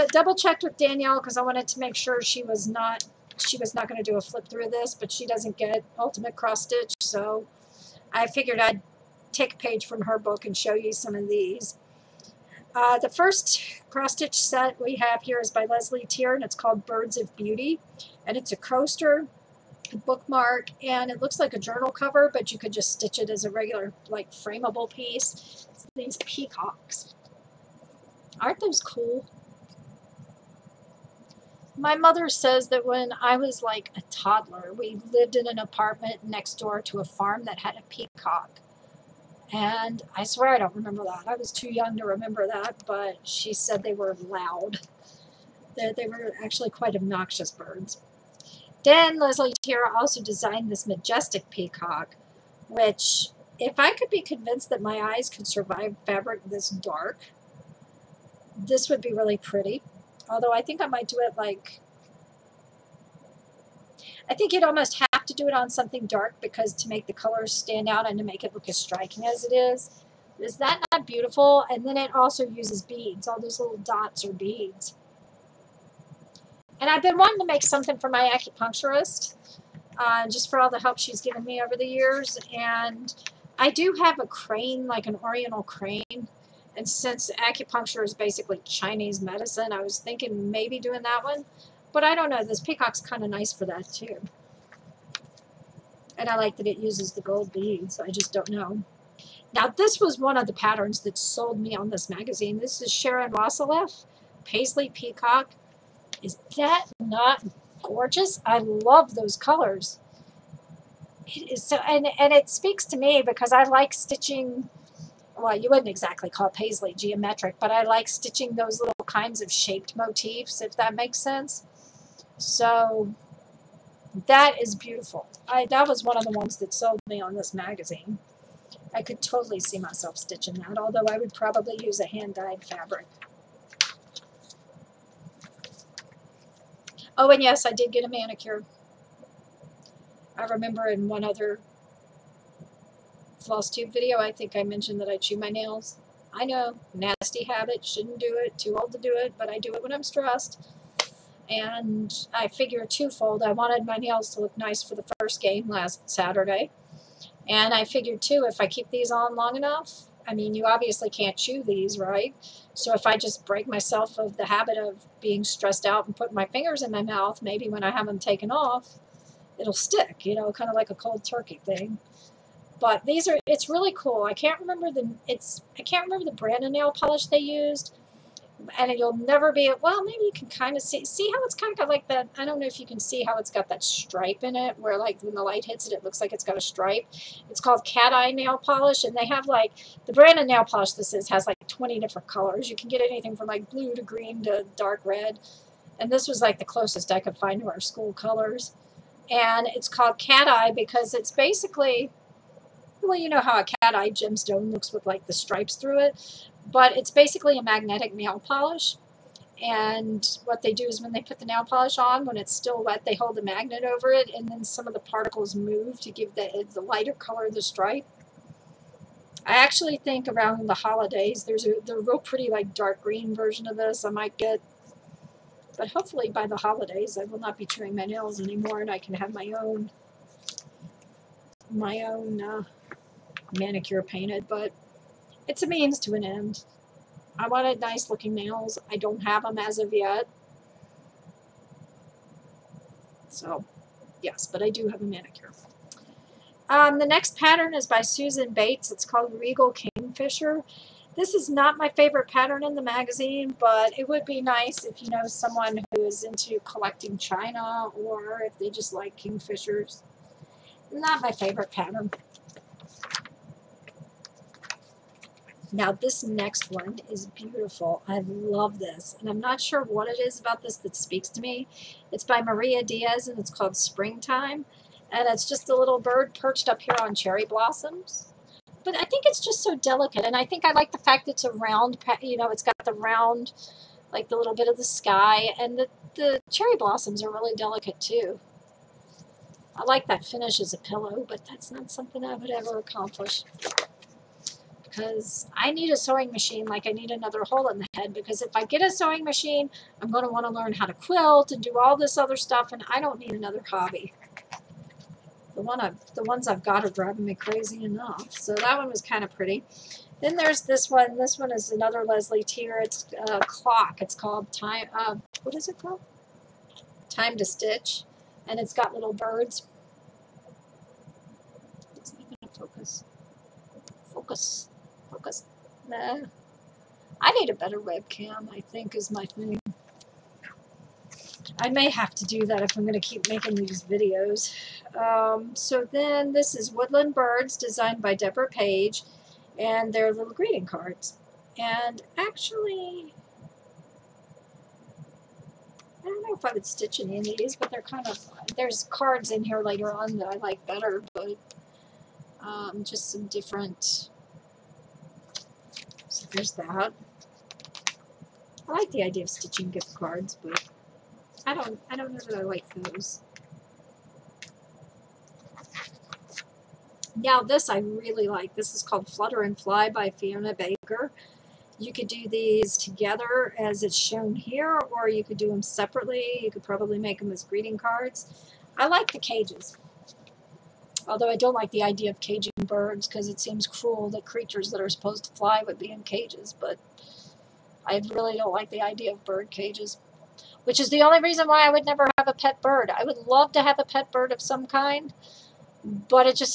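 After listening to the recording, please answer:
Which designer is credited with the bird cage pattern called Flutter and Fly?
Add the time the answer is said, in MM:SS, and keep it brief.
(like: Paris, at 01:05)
Fiona Baker, at 06:10.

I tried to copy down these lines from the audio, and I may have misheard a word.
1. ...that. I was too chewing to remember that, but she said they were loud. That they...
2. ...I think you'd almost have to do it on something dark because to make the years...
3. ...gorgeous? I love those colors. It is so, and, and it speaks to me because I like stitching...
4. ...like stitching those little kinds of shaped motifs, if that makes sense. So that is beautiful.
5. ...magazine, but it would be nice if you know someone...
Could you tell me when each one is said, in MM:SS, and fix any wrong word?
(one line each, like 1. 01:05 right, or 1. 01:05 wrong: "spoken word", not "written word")
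1. 00:41 wrong: "young", not "chewing"
2. 01:04 wrong: "colors", not "years"
3. 01:47 right
4. 01:57 right
5. 04:12 right.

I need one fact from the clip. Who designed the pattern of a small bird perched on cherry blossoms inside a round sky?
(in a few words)
Maria Diaz.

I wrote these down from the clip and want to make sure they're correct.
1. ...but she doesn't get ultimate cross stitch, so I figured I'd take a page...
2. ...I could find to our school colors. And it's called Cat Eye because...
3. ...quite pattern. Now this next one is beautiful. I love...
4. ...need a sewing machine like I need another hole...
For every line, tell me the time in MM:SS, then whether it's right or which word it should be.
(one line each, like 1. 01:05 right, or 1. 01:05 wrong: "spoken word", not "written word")
1. 00:04 right
2. 03:17 right
3. 04:21 wrong: "favorite", not "quite"
4. 04:55 right.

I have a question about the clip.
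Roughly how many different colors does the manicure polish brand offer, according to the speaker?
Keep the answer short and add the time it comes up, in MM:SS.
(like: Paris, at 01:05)
20, at 03:11.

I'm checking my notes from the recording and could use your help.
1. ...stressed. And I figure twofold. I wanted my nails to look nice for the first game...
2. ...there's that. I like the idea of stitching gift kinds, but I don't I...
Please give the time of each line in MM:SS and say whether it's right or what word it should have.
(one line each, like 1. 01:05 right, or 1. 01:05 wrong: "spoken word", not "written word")
1. 02:30 right
2. 05:56 wrong: "cards", not "kinds".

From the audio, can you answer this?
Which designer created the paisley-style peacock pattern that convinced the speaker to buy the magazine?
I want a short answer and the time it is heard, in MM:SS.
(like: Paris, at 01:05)
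Sharon Wasseleff, at 01:42.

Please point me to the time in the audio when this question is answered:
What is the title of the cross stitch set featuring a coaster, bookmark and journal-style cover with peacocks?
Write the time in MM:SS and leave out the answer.
00:16.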